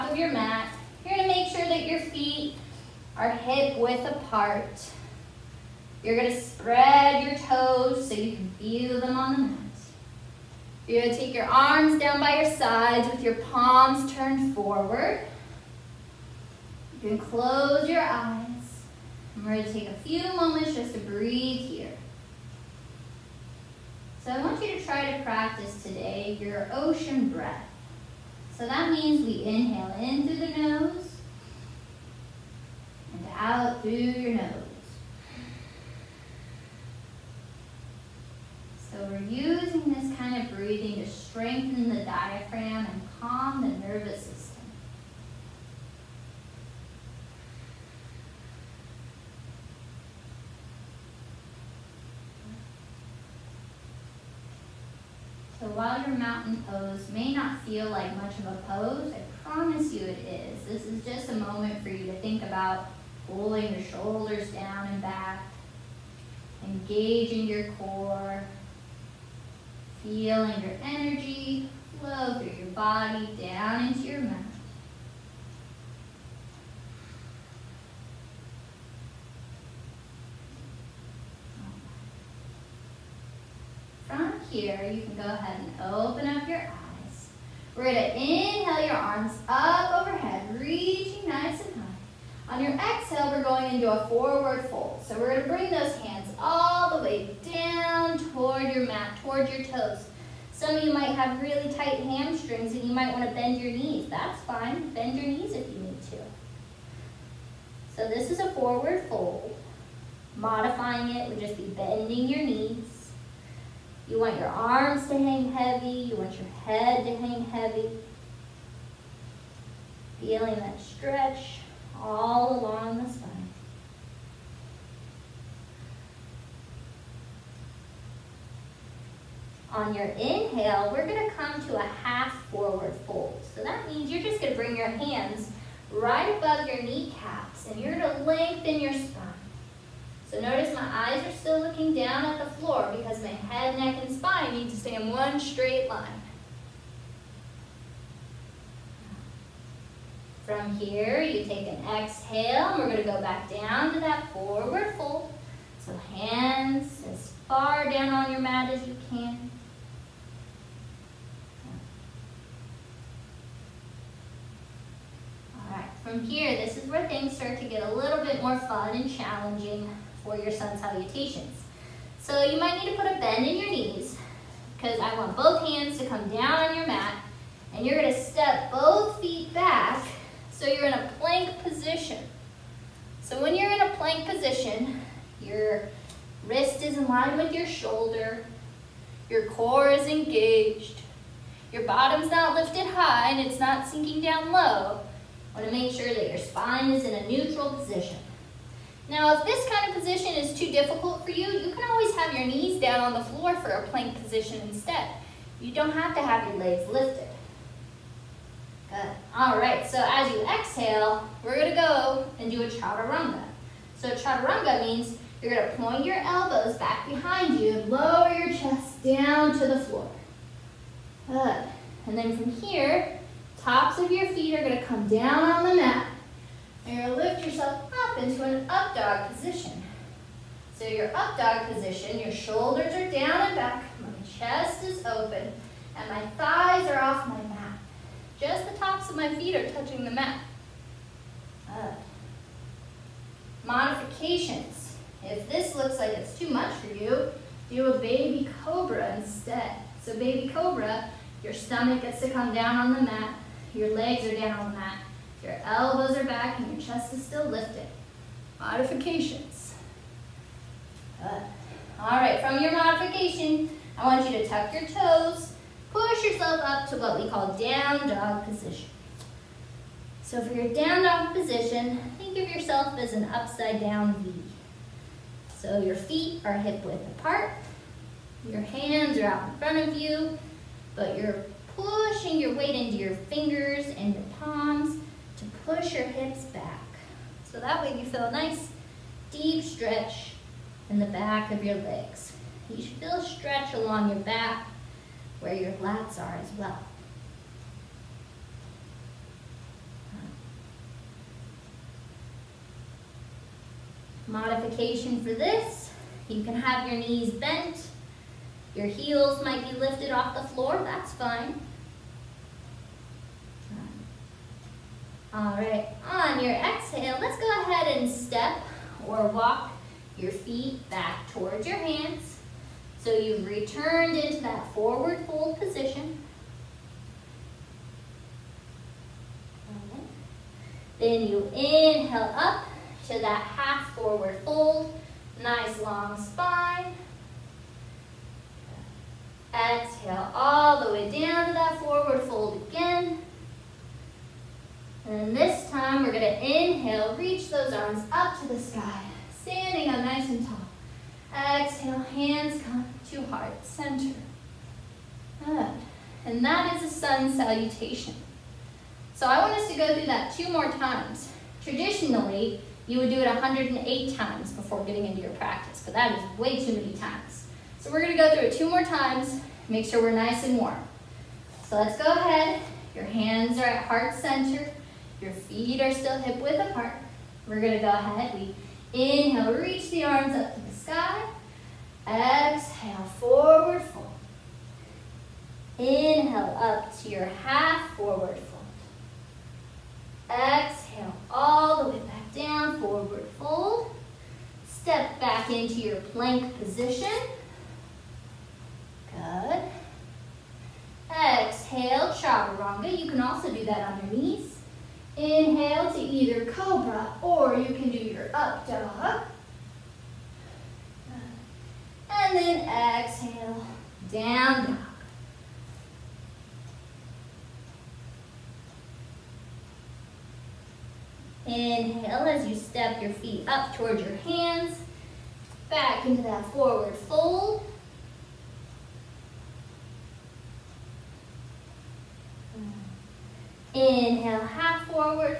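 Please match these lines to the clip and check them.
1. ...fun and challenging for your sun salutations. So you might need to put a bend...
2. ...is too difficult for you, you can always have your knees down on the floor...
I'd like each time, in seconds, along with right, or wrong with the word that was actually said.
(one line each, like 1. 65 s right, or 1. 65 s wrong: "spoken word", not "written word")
1. 168 s right
2. 200 s right.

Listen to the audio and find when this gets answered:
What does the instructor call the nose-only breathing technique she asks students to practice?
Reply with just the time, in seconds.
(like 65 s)
26 s.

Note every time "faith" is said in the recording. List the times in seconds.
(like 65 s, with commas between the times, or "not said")
not said.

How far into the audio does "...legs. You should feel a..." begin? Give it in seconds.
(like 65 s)
291 s.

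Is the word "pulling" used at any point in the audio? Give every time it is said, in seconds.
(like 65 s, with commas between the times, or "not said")
63 s.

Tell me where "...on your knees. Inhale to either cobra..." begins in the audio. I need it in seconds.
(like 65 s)
403 s.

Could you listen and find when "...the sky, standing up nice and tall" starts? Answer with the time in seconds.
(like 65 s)
348 s.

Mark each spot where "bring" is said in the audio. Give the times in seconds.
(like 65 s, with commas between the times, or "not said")
95 s, 134 s.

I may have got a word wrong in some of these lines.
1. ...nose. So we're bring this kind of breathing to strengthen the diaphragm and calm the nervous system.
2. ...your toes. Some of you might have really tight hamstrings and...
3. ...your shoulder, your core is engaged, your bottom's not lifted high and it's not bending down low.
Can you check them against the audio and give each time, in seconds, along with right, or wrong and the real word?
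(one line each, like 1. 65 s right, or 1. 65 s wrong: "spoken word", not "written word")
1. 34 s wrong: "using", not "bring"
2. 99 s right
3. 187 s wrong: "sinking", not "bending".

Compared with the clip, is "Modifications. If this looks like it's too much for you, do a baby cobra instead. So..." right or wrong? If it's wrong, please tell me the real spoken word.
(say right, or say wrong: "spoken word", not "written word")
right.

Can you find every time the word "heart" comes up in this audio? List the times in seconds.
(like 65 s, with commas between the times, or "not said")
353 s, 373 s.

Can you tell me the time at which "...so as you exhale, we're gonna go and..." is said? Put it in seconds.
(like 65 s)
209 s.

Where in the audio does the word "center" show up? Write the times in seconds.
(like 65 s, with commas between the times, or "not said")
353 s, 374 s.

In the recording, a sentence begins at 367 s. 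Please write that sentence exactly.
So we're gonna go through it two more times, make sure we're nice and warm.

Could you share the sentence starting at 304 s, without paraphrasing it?
Modification for this, you can have your knees bent, your heels might be lifted off the floor, that's fine.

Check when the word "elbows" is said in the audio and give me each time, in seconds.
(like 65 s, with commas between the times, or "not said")
216 s, 255 s.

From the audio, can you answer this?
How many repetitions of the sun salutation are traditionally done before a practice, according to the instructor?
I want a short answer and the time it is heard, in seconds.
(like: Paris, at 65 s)
108, at 363 s.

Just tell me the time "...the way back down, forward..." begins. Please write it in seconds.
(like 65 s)
391 s.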